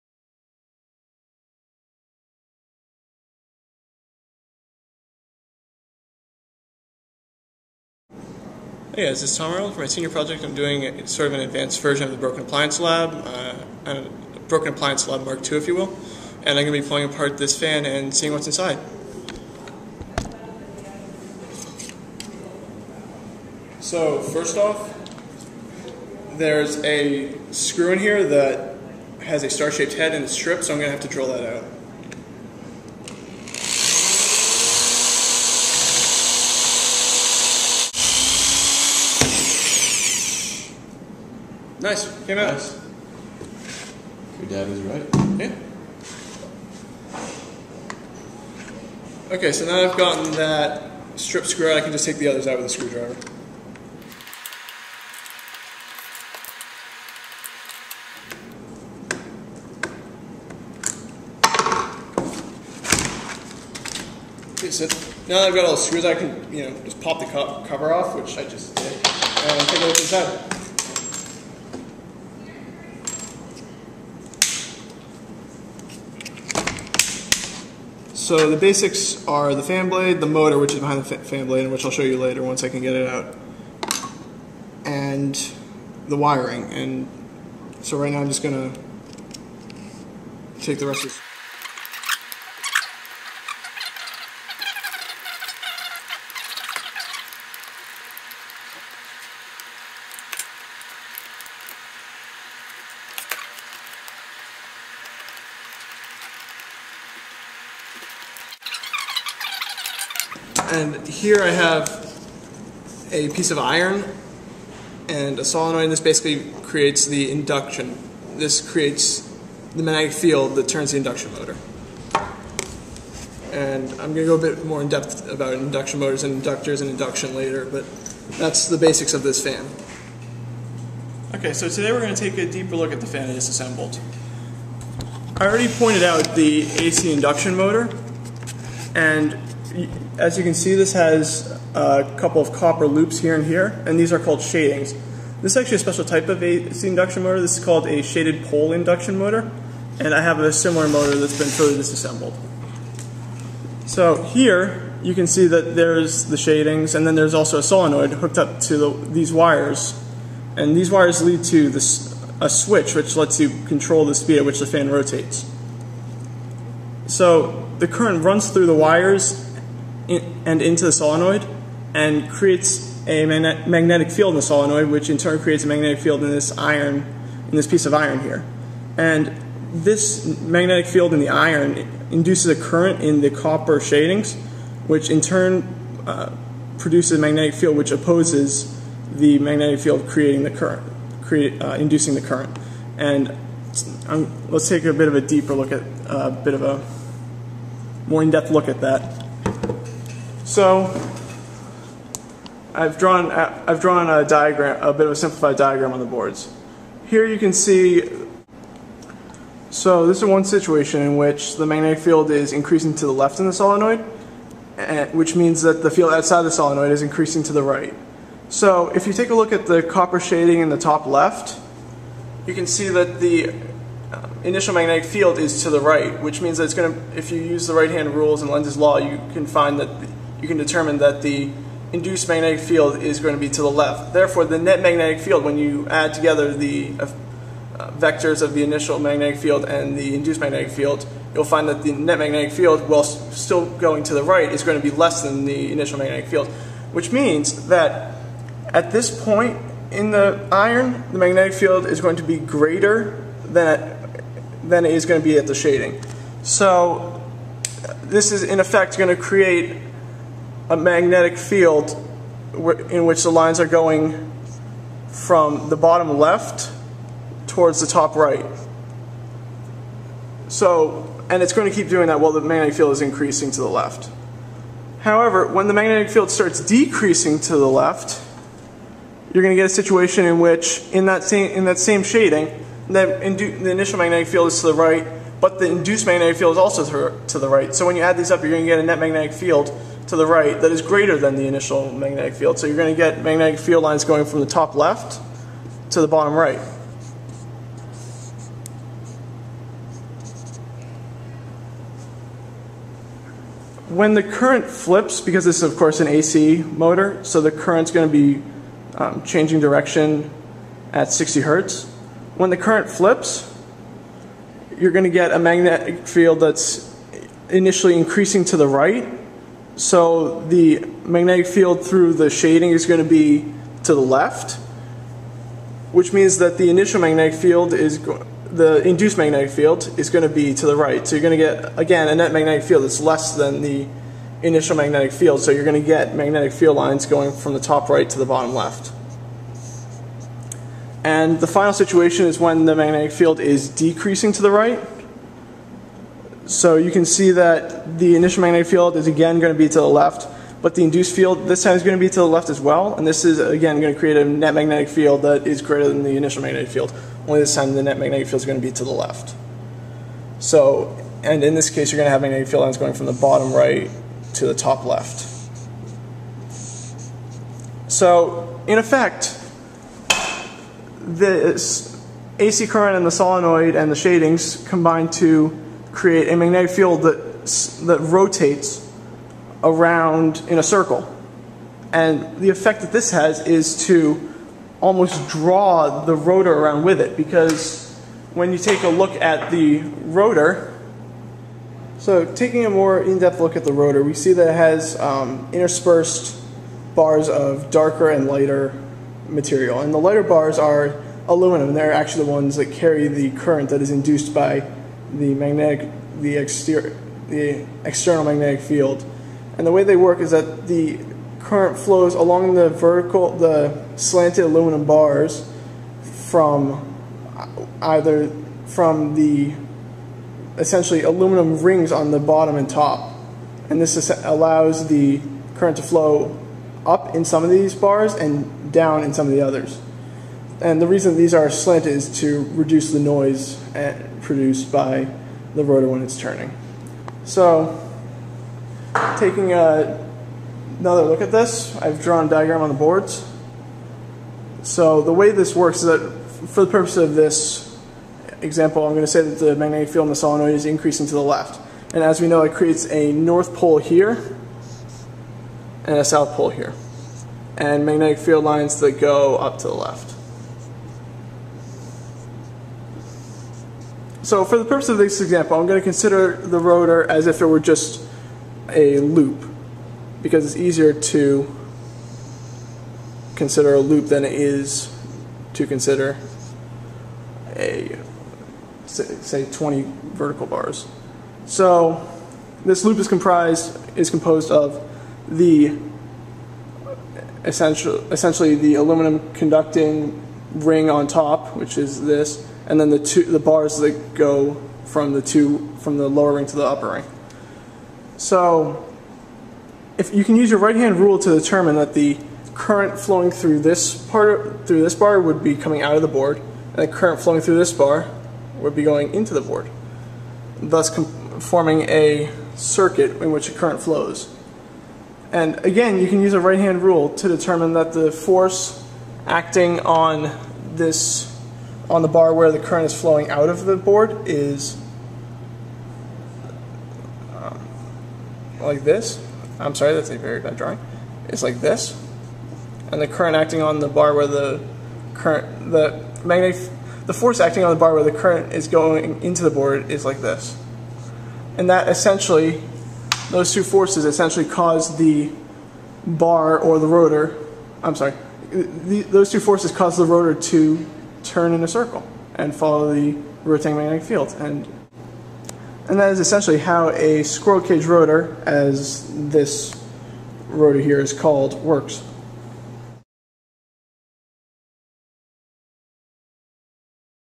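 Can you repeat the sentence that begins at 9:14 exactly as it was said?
And, and that is essentially how a squirrel cage rotor, as this rotor here is called, works.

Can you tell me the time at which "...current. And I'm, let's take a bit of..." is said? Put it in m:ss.
3:12.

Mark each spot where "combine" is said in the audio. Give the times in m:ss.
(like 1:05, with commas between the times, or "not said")
6:14.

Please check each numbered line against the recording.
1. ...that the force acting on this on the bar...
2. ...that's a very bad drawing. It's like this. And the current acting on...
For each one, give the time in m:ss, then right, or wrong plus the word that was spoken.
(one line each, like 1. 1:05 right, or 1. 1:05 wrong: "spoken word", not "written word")
1. 8:37 right
2. 8:49 right.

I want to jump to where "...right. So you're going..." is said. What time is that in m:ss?
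5:30.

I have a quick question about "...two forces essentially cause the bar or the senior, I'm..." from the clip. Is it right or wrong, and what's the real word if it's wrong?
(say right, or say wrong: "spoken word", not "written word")
wrong: "rotor", not "senior".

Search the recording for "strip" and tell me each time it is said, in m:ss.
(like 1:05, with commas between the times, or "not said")
0:30, 0:51.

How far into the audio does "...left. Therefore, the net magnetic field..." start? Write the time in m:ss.
3:53.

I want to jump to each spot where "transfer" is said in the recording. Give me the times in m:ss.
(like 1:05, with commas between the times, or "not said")
not said.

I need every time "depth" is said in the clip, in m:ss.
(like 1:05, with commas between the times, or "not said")
2:04, 3:18, 6:33.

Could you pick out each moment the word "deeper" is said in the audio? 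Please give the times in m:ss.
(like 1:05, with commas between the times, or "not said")
2:12, 3:15.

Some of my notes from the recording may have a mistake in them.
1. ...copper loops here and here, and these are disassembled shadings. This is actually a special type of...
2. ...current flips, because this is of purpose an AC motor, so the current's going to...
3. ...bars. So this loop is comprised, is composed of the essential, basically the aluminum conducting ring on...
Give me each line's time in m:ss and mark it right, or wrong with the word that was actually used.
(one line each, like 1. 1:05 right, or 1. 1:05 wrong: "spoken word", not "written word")
1. 2:22 wrong: "called", not "disassembled"
2. 5:04 wrong: "course", not "purpose"
3. 8:00 wrong: "essentially", not "basically".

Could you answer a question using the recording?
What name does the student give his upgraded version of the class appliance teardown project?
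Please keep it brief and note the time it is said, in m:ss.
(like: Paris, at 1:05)
Broken Appliance Lab Mark II, at 0:14.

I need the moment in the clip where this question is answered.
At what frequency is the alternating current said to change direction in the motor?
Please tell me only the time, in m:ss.
5:11.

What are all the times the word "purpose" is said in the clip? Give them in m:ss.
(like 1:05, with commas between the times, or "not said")
7:26, 7:44.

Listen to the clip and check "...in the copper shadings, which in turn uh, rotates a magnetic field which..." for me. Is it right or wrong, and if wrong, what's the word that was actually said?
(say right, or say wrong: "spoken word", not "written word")
wrong: "produces", not "rotates".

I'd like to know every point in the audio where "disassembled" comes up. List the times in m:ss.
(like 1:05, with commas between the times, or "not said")
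2:13, 2:31.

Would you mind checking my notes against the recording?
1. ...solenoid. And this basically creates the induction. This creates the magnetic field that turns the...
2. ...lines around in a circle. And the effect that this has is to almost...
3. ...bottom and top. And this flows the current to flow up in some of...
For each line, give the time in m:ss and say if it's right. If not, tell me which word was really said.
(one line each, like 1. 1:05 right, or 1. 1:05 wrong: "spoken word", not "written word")
1. 1:55 right
2. 6:18 wrong: "rotates", not "lines"
3. 7:02 wrong: "allows", not "flows".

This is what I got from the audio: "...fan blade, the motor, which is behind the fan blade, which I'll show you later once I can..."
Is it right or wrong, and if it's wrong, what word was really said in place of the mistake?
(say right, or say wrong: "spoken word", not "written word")
right.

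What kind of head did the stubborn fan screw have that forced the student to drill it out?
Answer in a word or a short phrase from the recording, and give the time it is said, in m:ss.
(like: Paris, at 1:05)
star-shaped, at 0:29.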